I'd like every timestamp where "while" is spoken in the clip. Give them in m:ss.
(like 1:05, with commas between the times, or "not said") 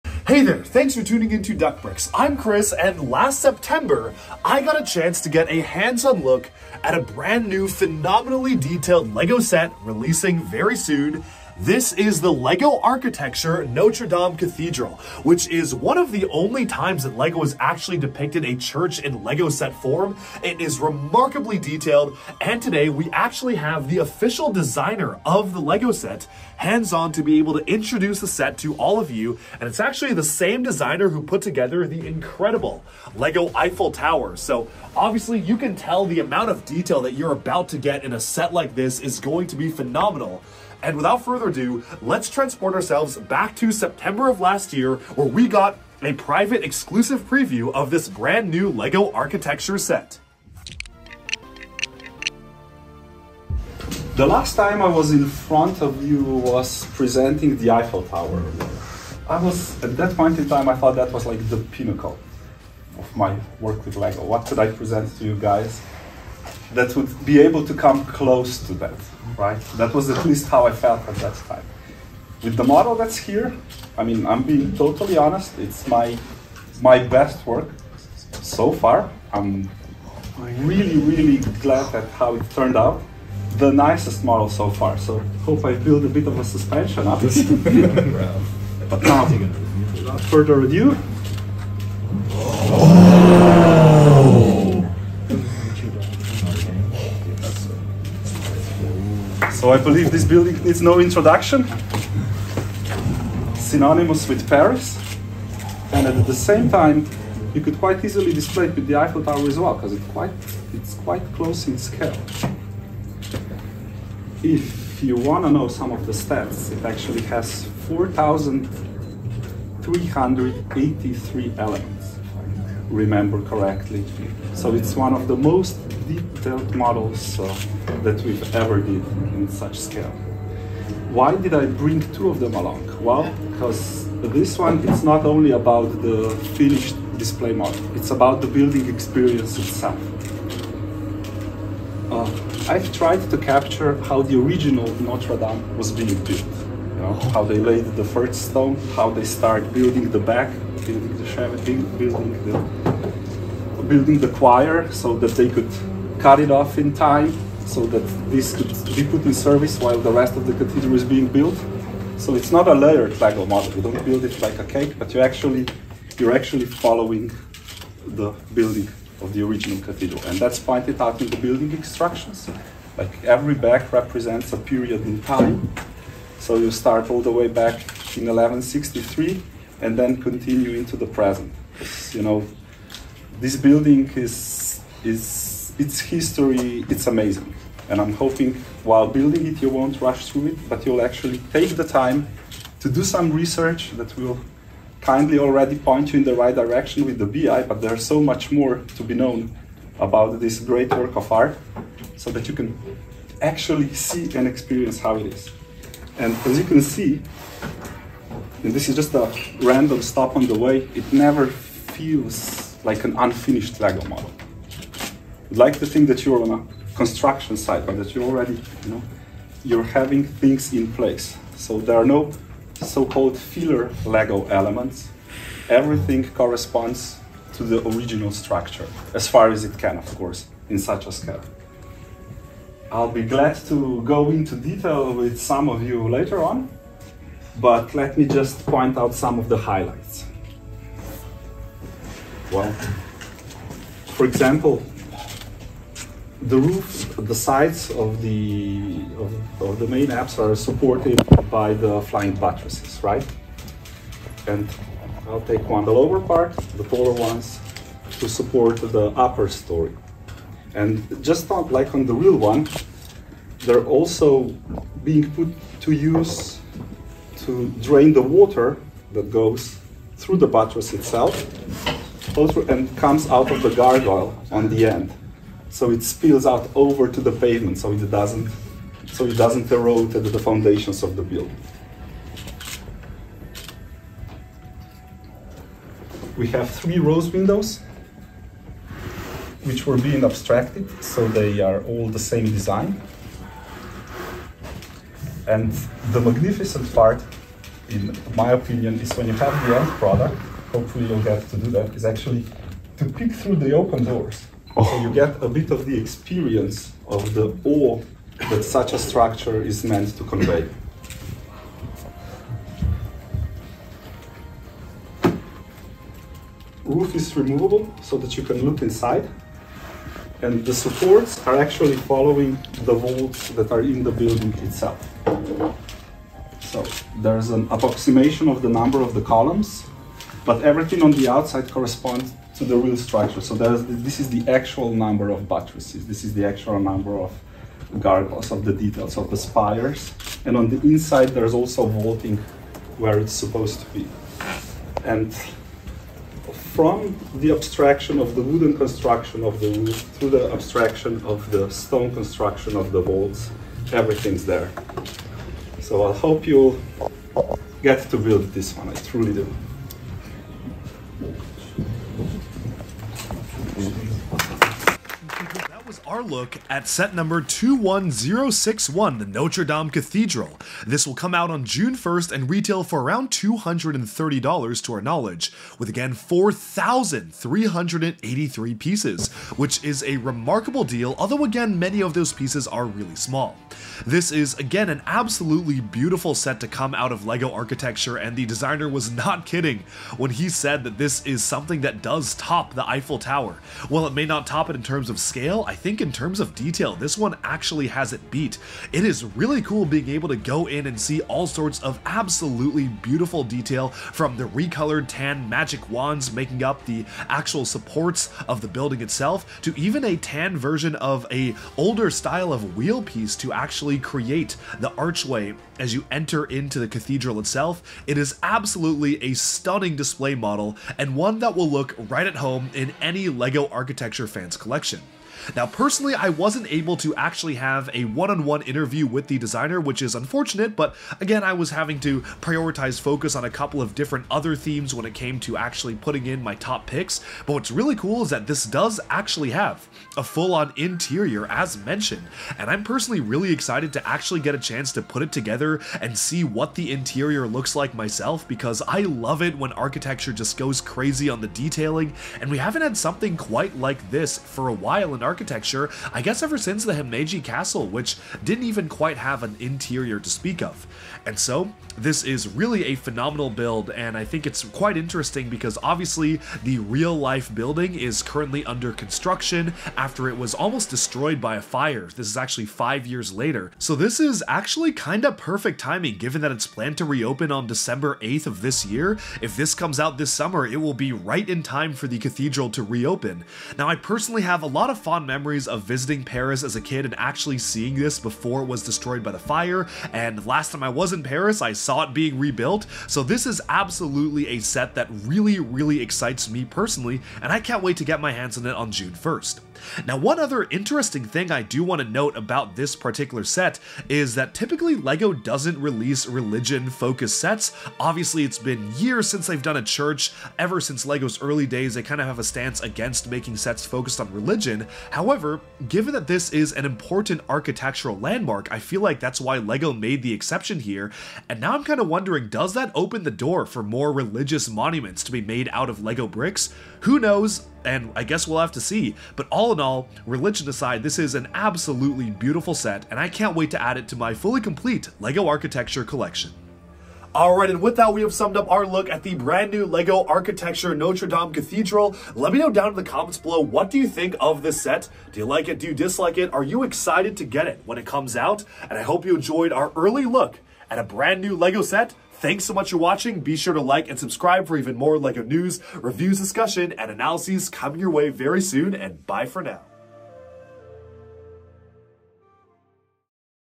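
2:39, 3:08, 6:33, 7:34.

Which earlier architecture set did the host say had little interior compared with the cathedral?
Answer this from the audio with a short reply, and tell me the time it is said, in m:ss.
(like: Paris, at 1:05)
Himeji Castle, at 7:36.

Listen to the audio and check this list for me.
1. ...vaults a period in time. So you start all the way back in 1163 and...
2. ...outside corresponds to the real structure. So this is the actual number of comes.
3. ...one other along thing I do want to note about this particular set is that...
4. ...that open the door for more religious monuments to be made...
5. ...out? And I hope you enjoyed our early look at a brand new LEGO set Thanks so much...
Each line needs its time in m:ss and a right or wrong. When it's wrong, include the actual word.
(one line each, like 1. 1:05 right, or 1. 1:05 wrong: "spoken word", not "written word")
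1. 2:53 wrong: "represents", not "vaults"
2. 5:31 wrong: "buttresses", not "comes"
3. 8:20 wrong: "interesting", not "along"
4. 8:42 right
5. 9:08 right.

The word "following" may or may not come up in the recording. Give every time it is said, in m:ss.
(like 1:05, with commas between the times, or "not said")
2:46, 5:21.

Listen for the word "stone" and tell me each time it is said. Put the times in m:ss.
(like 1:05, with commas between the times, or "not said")
2:28, 5:51.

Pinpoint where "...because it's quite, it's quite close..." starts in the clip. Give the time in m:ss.
1:49.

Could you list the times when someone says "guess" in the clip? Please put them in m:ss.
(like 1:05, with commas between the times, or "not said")
7:36, 8:48.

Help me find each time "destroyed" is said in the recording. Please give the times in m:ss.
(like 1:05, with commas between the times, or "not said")
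7:50, 8:08.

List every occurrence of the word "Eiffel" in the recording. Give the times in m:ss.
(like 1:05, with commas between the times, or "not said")
0:33, 0:57, 1:48, 6:32.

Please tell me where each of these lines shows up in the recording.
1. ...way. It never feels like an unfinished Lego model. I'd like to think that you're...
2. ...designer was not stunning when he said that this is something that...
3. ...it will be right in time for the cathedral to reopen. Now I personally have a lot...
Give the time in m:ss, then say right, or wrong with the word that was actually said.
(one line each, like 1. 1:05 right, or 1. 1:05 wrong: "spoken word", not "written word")
1. 3:30 right
2. 6:28 wrong: "kidding", not "stunning"
3. 8:00 right.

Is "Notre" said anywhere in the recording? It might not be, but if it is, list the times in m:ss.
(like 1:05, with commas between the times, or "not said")
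0:13, 2:25, 6:09, 9:00.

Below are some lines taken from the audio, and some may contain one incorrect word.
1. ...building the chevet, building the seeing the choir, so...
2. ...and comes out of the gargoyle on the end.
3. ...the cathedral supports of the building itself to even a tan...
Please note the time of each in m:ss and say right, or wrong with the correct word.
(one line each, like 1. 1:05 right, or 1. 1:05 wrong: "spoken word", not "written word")
1. 2:30 wrong: "building", not "seeing"
2. 4:32 right
3. 6:46 wrong: "actual", not "cathedral".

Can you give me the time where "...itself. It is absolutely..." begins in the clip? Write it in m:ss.
6:57.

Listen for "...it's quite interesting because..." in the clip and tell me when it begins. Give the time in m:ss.
7:44.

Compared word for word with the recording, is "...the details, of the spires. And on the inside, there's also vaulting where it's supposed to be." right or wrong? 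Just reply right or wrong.
right.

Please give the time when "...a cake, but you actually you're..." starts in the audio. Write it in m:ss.
2:44.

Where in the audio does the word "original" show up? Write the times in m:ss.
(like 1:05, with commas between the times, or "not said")
2:24, 2:49, 3:47.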